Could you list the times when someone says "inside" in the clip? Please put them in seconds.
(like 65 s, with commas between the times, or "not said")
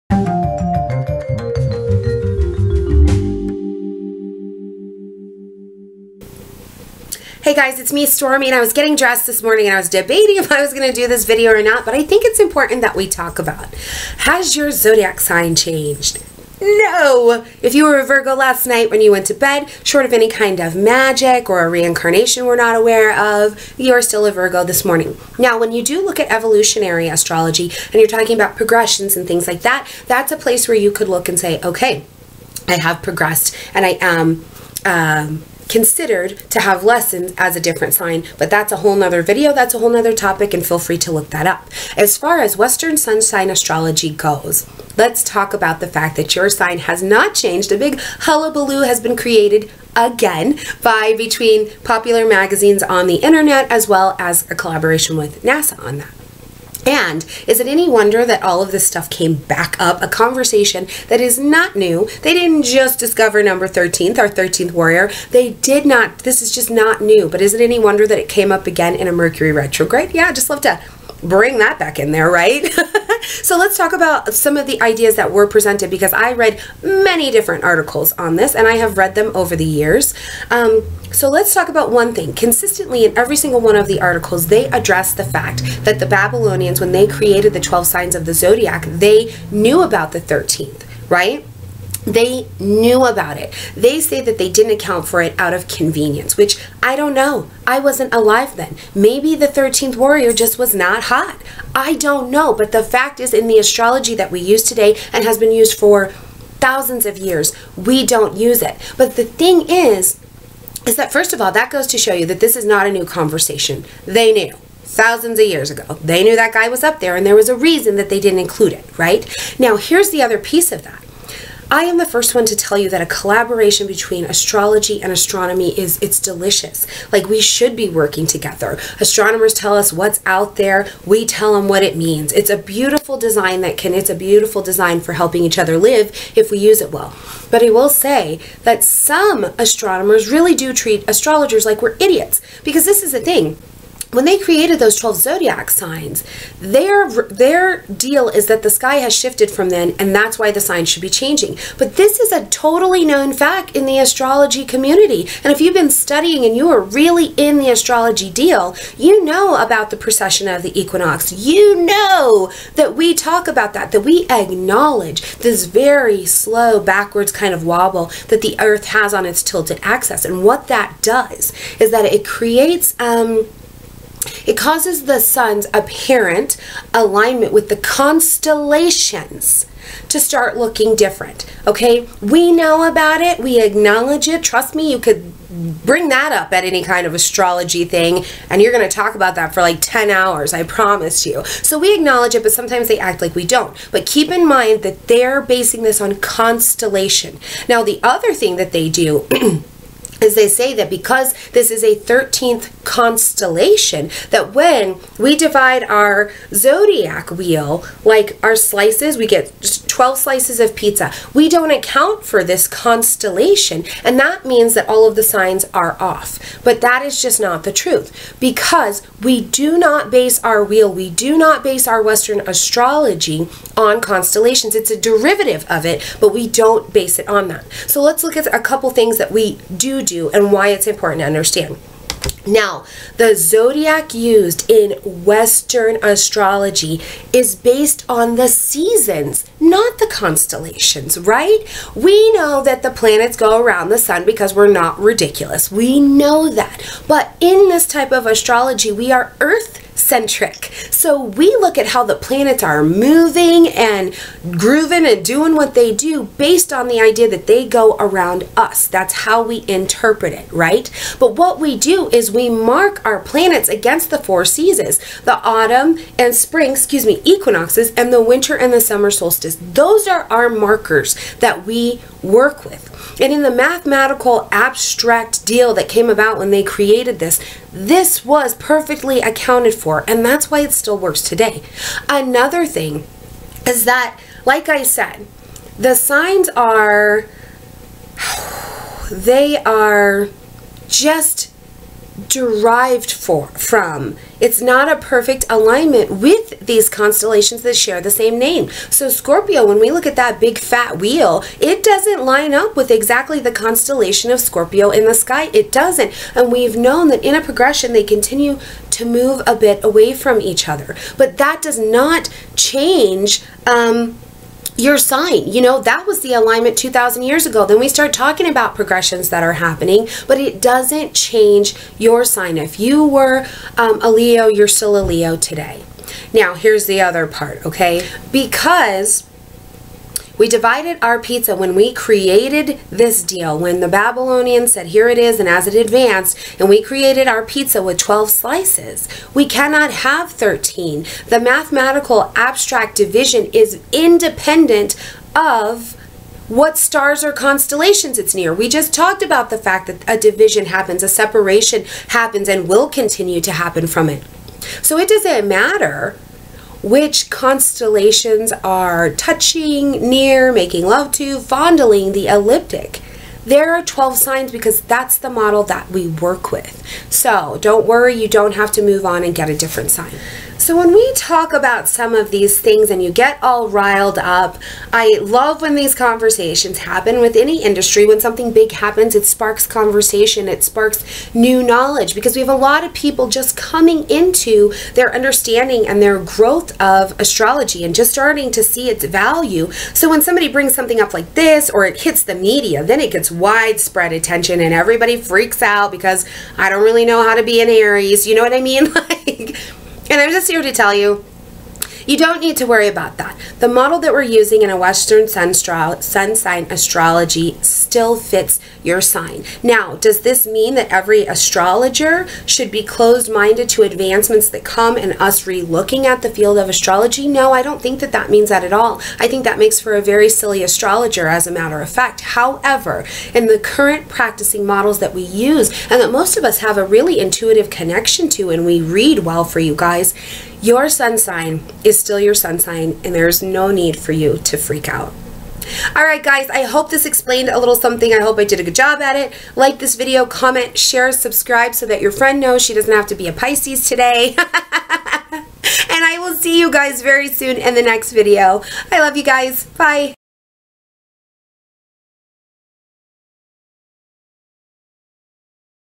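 not said.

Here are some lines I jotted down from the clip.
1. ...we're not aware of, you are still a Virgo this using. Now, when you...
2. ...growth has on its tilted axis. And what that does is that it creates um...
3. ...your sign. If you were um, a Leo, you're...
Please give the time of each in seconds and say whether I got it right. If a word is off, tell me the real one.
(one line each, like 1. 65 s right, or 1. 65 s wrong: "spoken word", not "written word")
1. 22 s wrong: "morning", not "using"
2. 168 s wrong: "earth", not "growth"
3. 321 s right.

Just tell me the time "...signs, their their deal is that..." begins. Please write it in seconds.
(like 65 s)
145 s.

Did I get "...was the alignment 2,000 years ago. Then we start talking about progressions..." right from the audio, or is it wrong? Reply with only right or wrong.
right.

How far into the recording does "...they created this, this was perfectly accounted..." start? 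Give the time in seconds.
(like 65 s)
276 s.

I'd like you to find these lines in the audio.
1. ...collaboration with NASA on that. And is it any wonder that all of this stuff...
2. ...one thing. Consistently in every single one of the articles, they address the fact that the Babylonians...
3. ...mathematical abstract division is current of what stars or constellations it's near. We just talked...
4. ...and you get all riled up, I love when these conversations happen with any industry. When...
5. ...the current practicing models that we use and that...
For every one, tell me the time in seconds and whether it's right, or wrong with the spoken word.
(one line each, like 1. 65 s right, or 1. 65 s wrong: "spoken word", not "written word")
1. 54 s right
2. 81 s right
3. 341 s wrong: "independent", not "current"
4. 372 s right
5. 423 s right.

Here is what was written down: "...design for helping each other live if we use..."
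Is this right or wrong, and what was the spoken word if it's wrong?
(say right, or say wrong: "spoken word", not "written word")
right.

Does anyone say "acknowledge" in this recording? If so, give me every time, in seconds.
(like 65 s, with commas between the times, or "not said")
164 s, 183 s, 191 s.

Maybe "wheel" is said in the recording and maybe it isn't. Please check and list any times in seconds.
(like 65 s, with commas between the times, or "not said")
207 s, 220 s, 300 s.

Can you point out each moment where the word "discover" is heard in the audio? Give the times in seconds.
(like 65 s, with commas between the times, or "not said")
62 s.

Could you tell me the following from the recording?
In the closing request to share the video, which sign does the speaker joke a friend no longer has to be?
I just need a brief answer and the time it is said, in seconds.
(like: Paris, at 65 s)
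Pisces, at 443 s.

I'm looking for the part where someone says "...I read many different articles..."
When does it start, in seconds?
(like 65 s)
76 s.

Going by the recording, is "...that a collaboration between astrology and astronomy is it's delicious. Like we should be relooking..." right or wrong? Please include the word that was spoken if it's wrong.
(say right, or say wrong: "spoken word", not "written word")
wrong: "working", not "relooking".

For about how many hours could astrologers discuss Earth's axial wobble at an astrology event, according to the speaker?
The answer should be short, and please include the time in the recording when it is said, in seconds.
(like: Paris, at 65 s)
10 hours, at 189 s.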